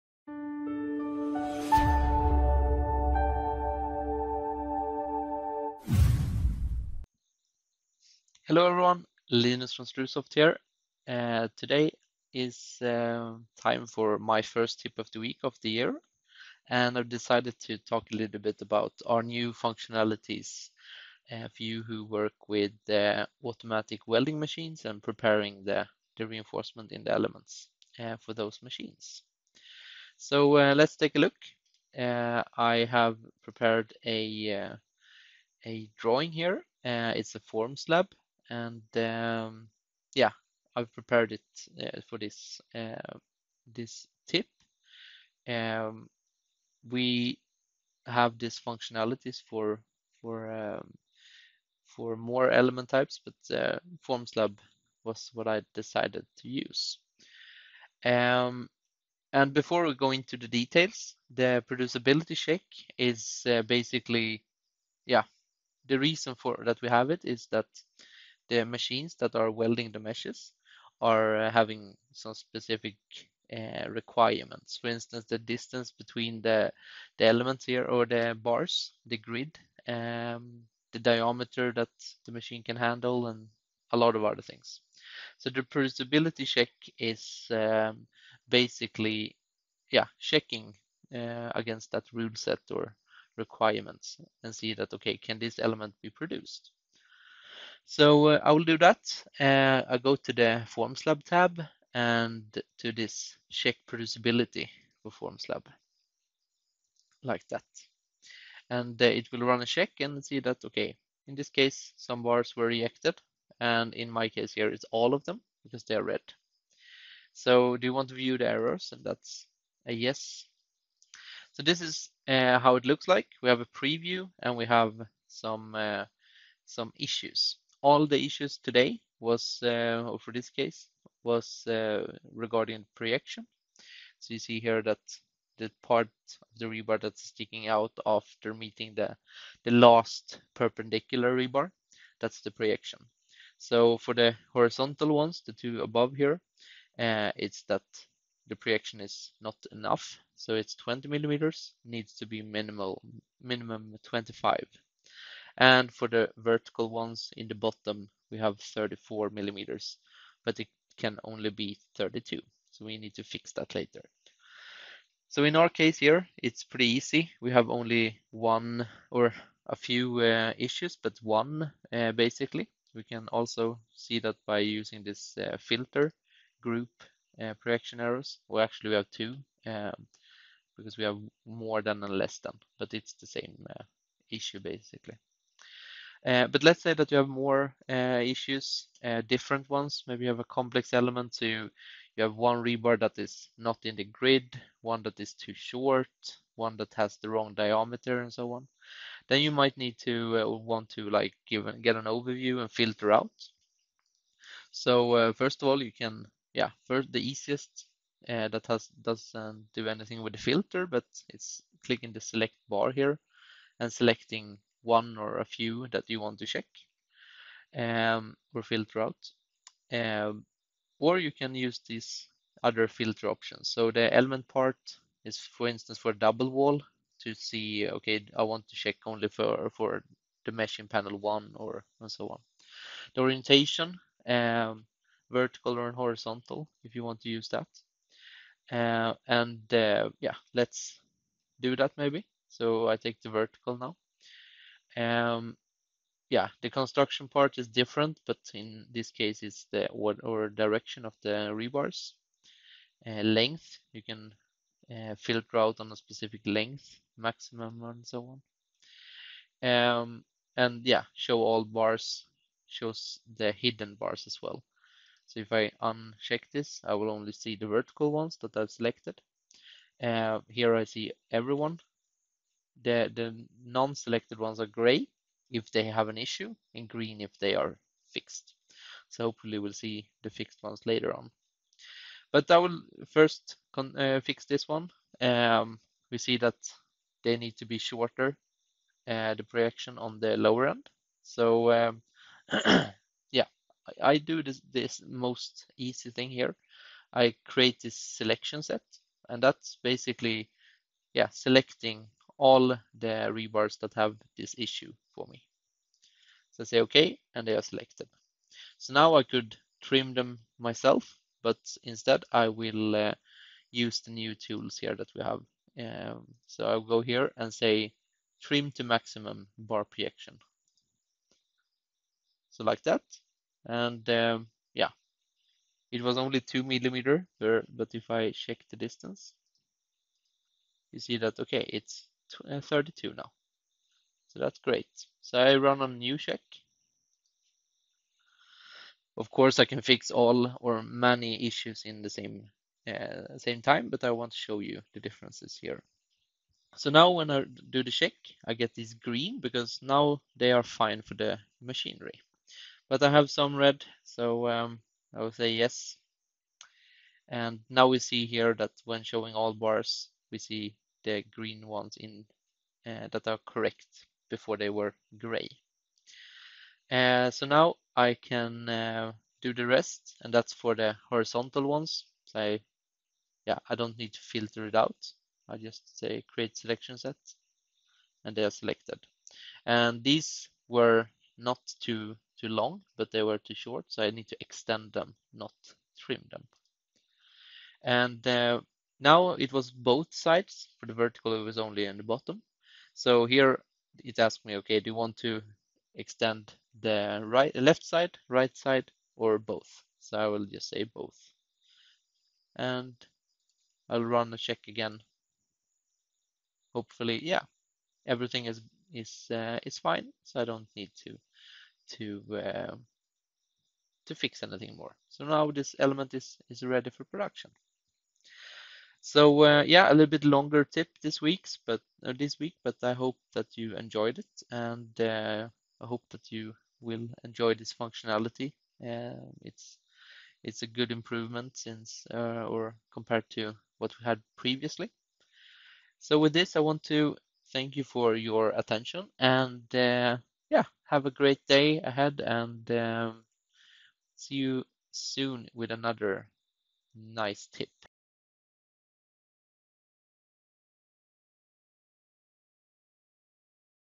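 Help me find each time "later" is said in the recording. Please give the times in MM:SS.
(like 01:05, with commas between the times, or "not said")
02:43, 04:40.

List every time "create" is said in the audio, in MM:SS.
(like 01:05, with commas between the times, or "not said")
04:57, 06:16.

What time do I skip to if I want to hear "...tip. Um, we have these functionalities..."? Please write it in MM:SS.
00:44.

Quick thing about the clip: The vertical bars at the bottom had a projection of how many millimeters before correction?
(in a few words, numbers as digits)
34.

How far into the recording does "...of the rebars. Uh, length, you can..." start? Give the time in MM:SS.
04:11.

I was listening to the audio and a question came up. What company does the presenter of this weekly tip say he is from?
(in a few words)
Strusoft.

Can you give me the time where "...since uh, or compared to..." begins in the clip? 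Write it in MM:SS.
07:11.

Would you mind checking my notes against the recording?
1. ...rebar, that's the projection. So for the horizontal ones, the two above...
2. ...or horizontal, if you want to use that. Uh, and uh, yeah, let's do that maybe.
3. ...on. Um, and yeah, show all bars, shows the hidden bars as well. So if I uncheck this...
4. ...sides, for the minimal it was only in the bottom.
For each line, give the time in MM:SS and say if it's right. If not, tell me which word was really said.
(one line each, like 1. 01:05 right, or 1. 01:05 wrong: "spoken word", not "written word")
1. 02:21 right
2. 03:55 right
3. 04:19 right
4. 06:30 wrong: "vertical", not "minimal".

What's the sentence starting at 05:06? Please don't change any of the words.
So I say okay, and they are selected.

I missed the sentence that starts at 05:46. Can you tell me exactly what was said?
So now when I do the check, I get these green because now they are fine for the machinery.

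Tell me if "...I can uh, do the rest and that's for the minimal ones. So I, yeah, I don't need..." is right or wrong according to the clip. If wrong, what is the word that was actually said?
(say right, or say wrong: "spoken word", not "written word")
wrong: "horizontal", not "minimal".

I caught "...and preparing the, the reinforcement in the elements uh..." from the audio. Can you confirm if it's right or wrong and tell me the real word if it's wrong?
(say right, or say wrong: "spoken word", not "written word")
right.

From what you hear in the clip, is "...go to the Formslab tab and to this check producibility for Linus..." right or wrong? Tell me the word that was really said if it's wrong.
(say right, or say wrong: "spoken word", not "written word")
wrong: "Formslab", not "Linus".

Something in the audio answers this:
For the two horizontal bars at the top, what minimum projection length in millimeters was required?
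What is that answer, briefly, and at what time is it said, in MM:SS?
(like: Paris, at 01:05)
25, at 02:34.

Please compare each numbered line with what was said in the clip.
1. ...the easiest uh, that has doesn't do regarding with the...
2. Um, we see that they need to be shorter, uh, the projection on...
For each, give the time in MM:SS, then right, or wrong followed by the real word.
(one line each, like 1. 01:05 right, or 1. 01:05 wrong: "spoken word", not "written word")
1. 03:27 wrong: "anything", not "regarding"
2. 04:45 right.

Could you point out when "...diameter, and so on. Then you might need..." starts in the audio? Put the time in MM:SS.
03:17.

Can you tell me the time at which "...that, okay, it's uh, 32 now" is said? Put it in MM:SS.
05:31.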